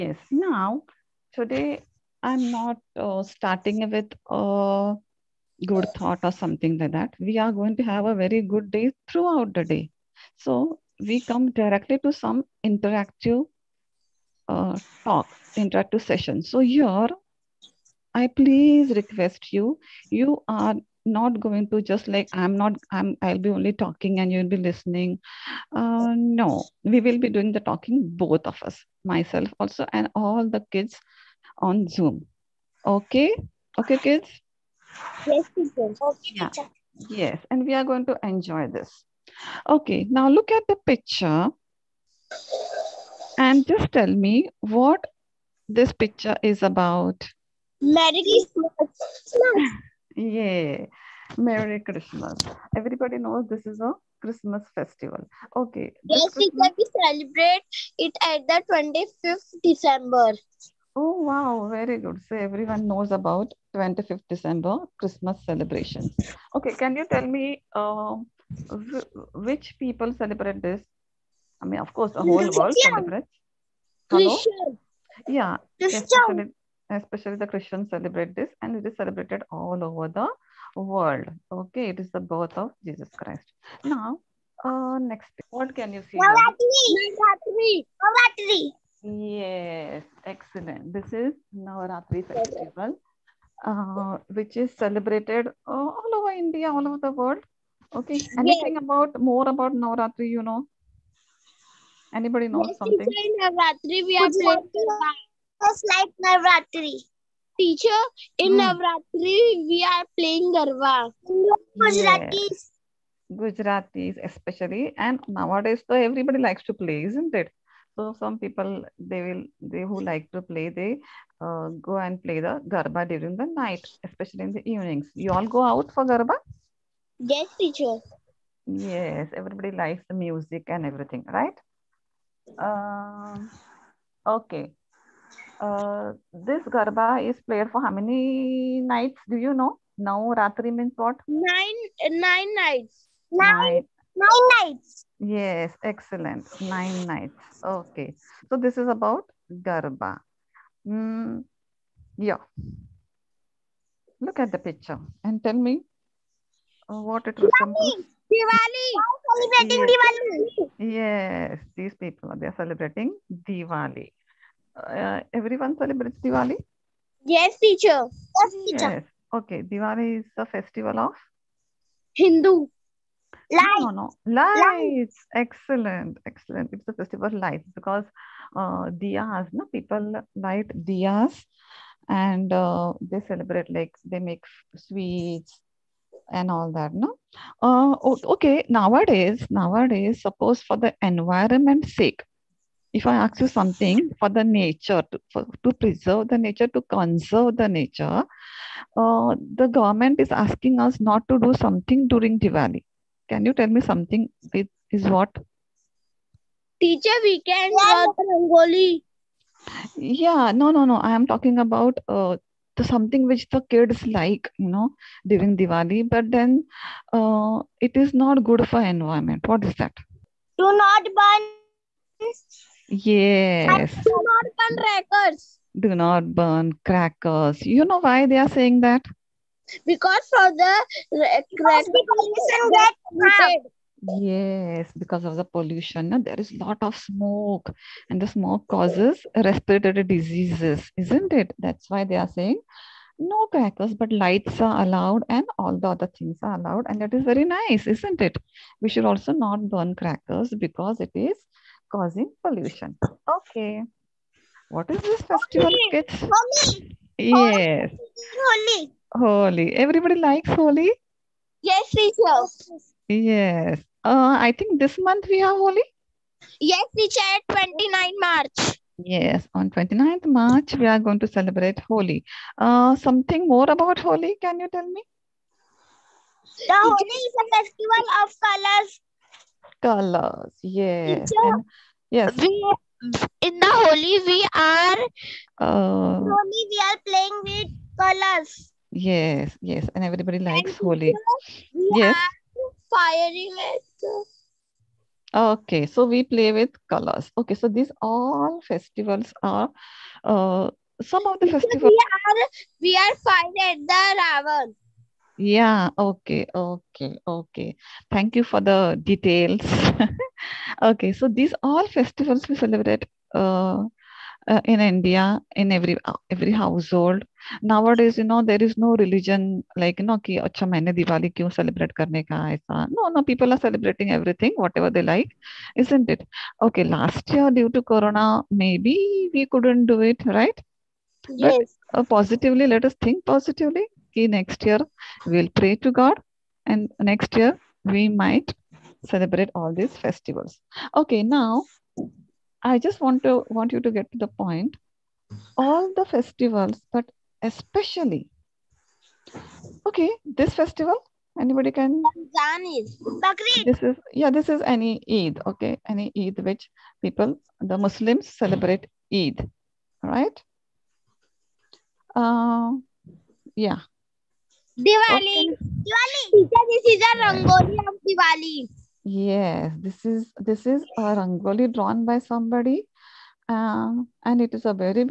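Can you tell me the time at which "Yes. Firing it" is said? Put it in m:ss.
4:51.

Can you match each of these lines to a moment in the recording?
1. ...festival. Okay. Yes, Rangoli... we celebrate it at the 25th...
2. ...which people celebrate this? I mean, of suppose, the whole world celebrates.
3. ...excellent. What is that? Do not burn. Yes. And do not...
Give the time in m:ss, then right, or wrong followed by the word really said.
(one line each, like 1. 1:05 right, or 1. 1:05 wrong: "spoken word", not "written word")
1. 0:54 wrong: "Christmas", not "Rangoli"
2. 1:09 wrong: "course", not "suppose"
3. 3:38 wrong: "environment", not "excellent".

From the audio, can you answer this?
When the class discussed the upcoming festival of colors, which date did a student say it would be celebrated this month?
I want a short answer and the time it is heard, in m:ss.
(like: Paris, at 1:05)
29 March, at 4:27.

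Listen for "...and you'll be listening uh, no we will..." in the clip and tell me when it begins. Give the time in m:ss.
0:24.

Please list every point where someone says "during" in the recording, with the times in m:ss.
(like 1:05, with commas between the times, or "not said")
2:03, 3:22, 3:35.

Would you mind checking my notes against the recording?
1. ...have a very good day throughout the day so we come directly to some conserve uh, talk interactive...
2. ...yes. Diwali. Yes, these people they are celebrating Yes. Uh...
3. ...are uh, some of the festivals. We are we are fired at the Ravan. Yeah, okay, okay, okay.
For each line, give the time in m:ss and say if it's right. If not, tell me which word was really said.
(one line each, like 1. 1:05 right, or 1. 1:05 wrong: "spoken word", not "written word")
1. 0:07 wrong: "interactive", not "conserve"
2. 2:39 wrong: "Diwali", not "Yes"
3. 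4:59 right.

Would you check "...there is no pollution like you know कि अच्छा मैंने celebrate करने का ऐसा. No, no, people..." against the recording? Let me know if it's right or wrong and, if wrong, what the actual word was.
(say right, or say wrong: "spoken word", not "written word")
wrong: "religion", not "pollution".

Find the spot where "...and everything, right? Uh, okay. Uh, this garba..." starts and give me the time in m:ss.
2:10.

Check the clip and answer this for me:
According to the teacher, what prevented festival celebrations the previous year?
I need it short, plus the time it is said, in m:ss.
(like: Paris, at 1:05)
Corona, at 5:27.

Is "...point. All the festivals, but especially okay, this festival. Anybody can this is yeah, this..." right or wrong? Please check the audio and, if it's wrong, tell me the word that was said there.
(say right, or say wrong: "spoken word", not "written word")
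right.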